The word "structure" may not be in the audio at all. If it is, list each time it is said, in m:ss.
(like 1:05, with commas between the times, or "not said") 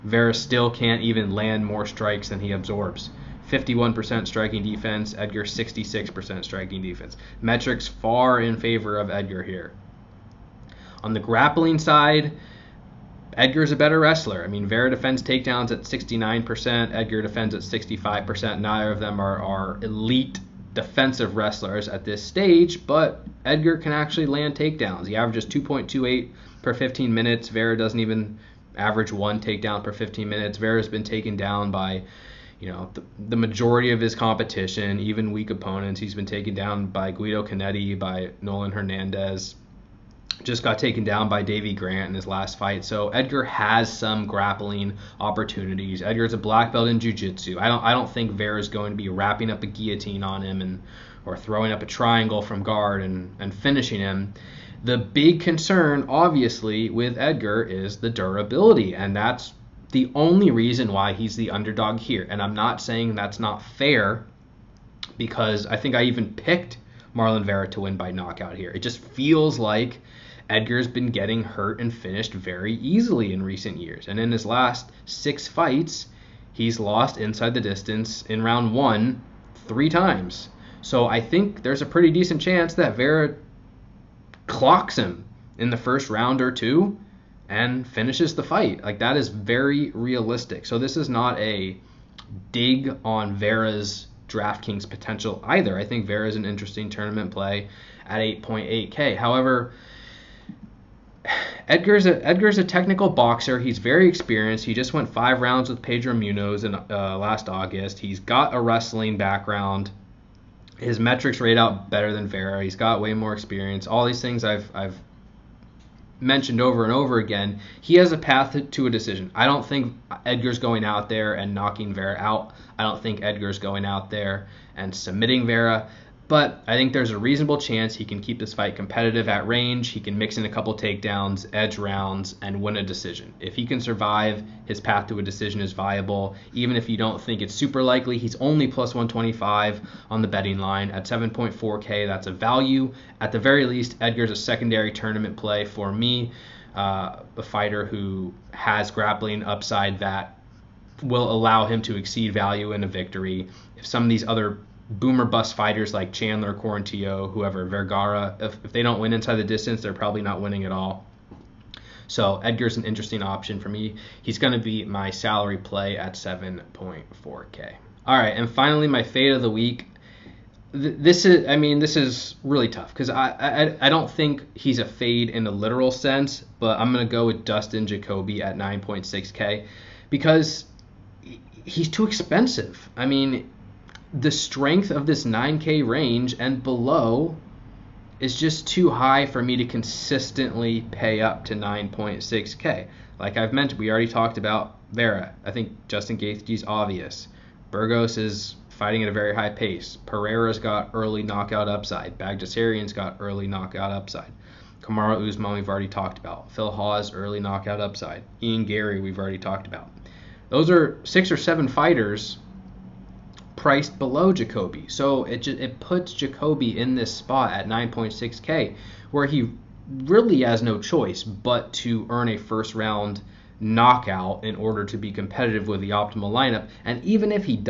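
not said.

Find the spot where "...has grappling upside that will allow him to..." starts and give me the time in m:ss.
2:28.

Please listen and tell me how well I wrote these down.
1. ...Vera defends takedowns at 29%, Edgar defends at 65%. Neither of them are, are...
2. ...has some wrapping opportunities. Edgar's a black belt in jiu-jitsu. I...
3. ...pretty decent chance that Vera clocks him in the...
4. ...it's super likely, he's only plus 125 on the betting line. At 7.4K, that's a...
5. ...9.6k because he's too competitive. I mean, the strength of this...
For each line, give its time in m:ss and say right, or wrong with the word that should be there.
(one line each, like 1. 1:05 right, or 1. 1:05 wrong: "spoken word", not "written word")
1. 0:14 wrong: "69", not "29"
2. 0:43 wrong: "grappling", not "wrapping"
3. 1:21 right
4. 2:17 right
5. 2:58 wrong: "expensive", not "competitive".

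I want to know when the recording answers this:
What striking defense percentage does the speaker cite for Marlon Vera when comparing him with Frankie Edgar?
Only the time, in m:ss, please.
0:03.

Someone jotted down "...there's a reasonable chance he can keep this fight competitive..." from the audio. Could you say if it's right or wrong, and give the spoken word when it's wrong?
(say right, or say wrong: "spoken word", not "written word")
right.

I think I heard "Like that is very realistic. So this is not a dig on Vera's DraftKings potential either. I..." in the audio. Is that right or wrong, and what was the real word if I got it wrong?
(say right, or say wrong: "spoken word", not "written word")
right.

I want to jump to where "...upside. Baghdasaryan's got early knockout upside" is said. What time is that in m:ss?
3:21.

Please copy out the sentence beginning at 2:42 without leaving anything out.
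So Edgar's an interesting option for me.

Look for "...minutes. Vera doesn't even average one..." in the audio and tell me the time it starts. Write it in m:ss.
0:27.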